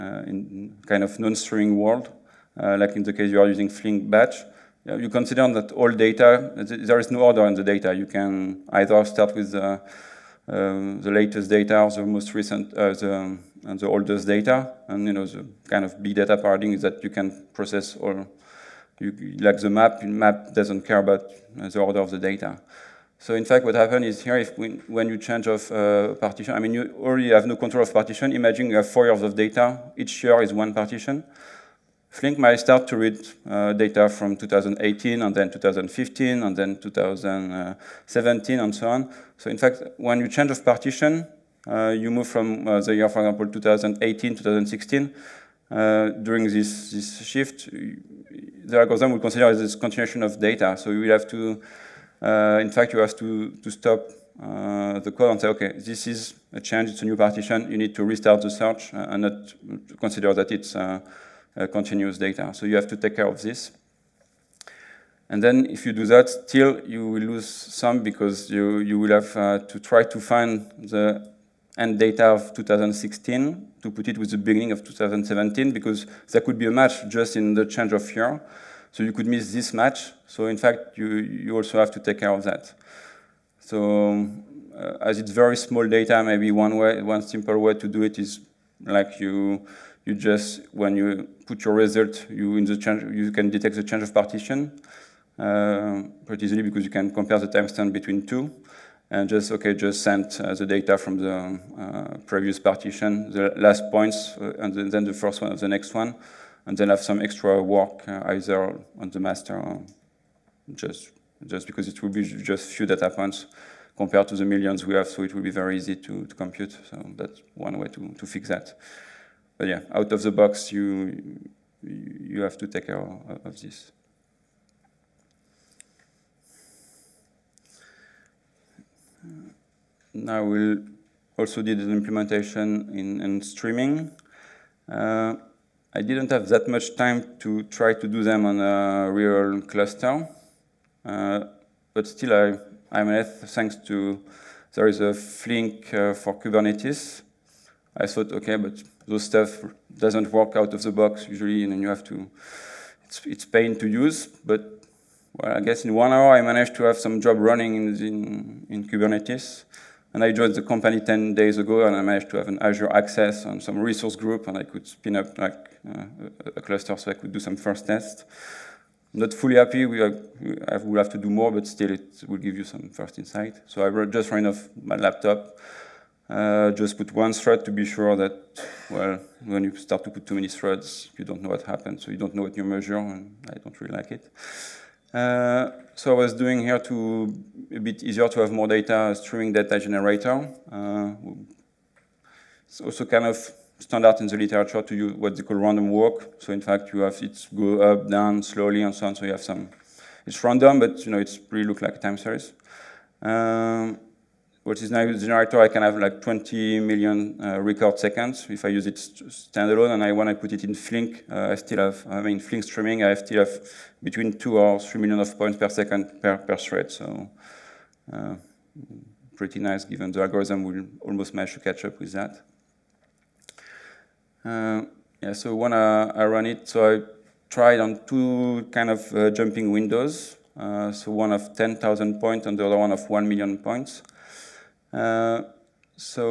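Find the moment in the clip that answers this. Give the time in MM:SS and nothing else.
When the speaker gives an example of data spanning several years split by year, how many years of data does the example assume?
00:28.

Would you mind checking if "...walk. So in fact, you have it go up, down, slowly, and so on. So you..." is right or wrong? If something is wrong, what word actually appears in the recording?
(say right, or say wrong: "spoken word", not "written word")
right.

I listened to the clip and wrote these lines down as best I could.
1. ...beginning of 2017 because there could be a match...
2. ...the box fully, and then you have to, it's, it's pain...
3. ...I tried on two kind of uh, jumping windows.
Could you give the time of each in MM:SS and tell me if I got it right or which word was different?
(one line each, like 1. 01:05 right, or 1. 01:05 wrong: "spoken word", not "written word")
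1. 01:14 right
2. 02:30 wrong: "usually", not "fully"
3. 03:47 right.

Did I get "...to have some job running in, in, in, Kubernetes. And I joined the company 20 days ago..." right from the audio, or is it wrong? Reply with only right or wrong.
wrong.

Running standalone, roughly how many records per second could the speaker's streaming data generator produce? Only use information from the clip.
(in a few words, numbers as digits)
20 million.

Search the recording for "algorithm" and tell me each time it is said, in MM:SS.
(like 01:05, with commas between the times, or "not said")
00:48, 03:40.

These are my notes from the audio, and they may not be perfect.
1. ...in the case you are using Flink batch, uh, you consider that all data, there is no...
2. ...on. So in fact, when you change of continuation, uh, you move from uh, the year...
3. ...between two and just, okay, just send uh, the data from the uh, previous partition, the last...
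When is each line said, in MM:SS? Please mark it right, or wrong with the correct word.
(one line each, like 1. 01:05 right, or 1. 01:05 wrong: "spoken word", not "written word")
1. 00:02 right
2. 00:38 wrong: "partition", not "continuation"
3. 01:37 right.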